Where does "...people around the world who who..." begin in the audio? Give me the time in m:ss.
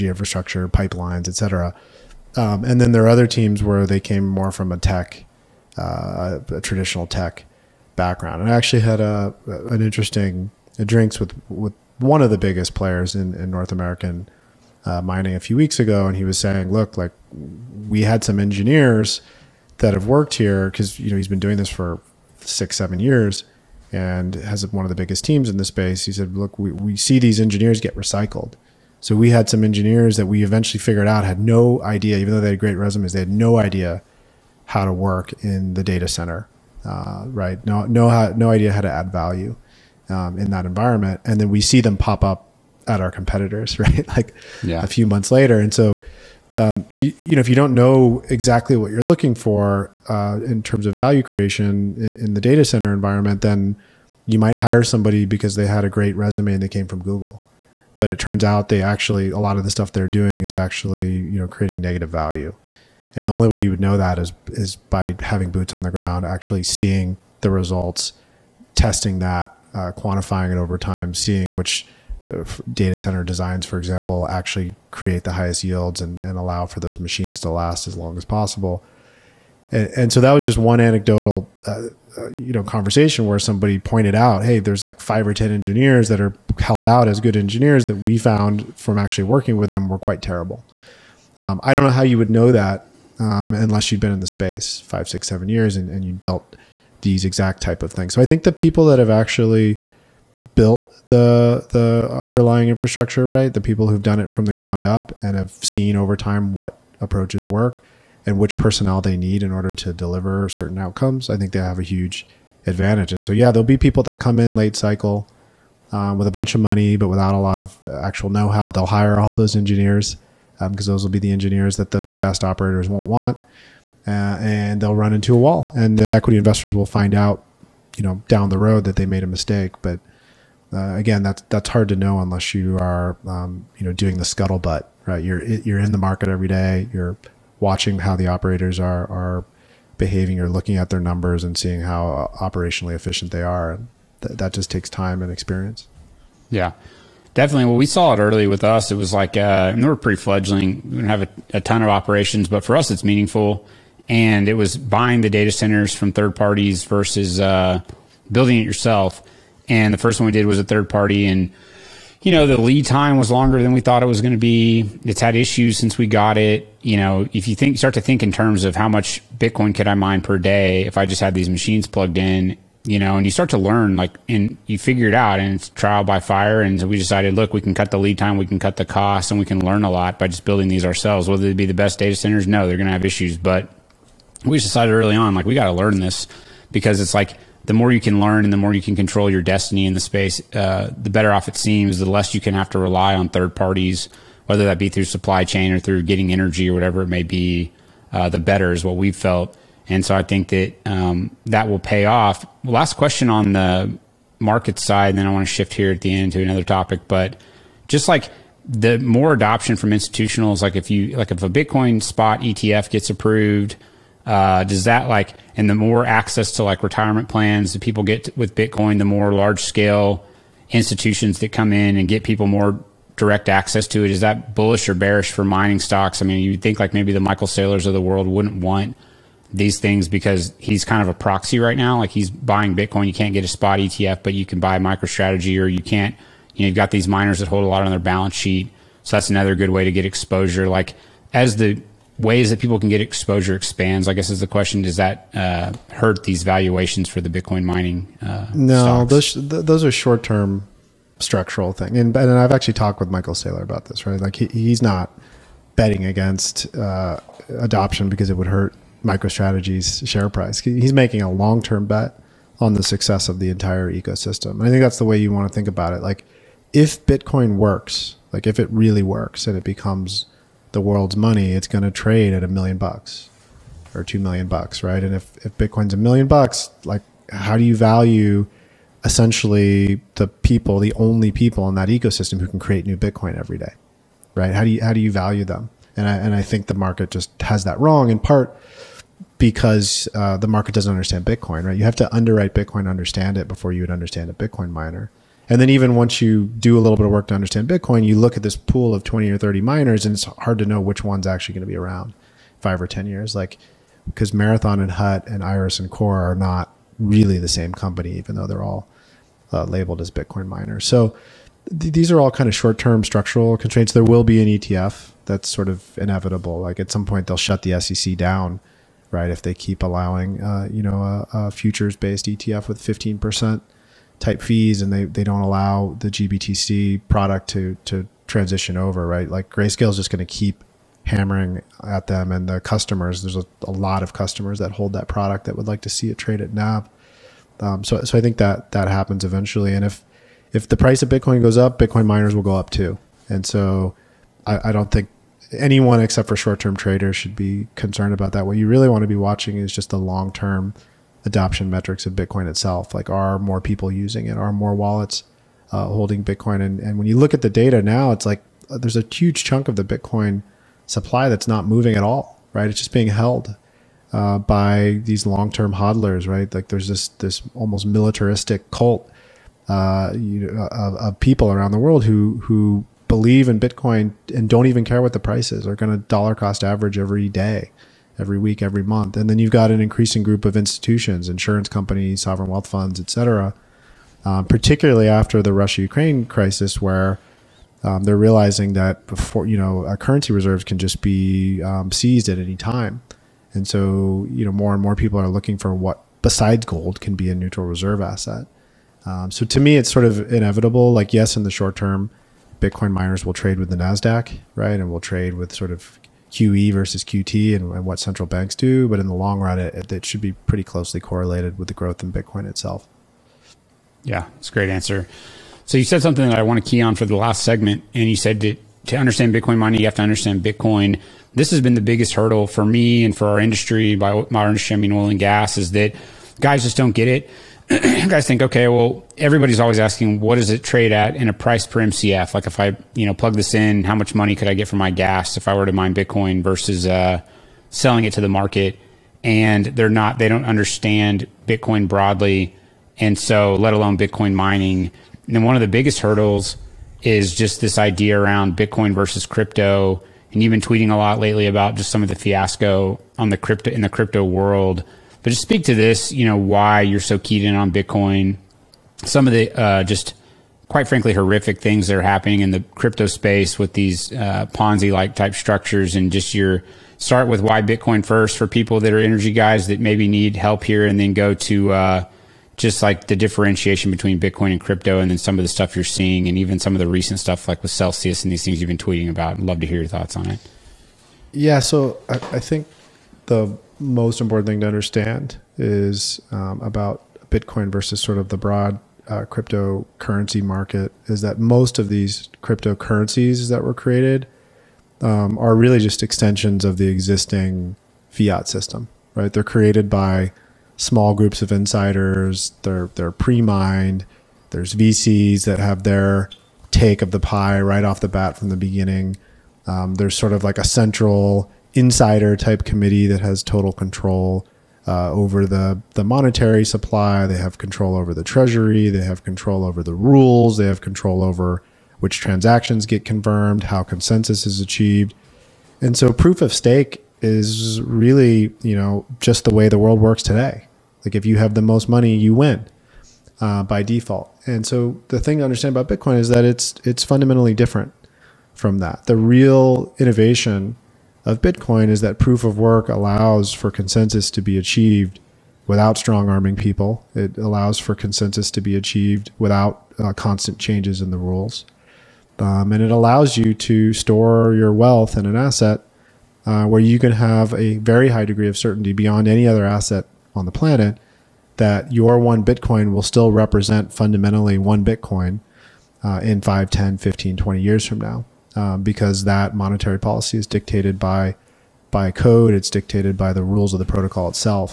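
6:11.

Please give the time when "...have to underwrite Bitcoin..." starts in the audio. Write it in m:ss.
4:51.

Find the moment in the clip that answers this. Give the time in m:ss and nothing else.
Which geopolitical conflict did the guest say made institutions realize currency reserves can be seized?
6:25.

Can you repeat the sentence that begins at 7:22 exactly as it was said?
And so, let alone Bitcoin mining.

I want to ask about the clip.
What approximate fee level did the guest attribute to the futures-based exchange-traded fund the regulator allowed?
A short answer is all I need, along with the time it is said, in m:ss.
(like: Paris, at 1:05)
15%, at 5:22.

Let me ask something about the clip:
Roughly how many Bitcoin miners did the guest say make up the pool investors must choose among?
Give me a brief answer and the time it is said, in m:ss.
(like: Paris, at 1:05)
20 or 30, at 4:59.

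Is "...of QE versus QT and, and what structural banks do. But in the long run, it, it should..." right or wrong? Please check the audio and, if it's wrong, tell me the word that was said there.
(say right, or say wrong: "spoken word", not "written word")
wrong: "central", not "structural".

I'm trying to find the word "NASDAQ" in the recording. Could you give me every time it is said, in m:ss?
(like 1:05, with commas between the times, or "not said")
6:43.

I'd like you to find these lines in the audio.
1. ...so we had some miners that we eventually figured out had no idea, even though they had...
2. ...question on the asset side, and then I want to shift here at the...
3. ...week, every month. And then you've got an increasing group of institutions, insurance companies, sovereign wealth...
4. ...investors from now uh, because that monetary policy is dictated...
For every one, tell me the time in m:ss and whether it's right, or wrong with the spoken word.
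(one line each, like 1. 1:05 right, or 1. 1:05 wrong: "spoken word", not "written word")
1. 0:29 wrong: "engineers", not "miners"
2. 3:22 wrong: "market", not "asset"
3. 6:18 right
4. 9:27 wrong: "years", not "investors".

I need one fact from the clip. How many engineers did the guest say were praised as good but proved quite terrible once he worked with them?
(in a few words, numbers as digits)
five or ten.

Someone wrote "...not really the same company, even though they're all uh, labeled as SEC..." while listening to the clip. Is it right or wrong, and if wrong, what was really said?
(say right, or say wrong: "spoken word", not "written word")
wrong: "Bitcoin", not "SEC".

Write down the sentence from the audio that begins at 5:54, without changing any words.
Are more wallets uh, holding Bitcoin?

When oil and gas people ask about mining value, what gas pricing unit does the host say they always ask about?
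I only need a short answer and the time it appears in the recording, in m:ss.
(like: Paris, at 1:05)
price per MCF, at 7:11.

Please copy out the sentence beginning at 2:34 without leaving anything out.
And it was buying the data centers from third parties versus uh, building it yourself.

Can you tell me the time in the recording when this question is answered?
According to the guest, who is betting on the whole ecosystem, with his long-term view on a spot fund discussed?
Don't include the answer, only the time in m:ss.
4:12.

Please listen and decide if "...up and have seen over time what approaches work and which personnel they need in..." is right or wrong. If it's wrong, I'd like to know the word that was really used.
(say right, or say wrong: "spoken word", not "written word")
right.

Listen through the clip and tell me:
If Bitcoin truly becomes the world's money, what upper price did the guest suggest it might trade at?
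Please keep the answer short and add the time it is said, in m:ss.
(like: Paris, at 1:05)
2 million dollars, at 4:34.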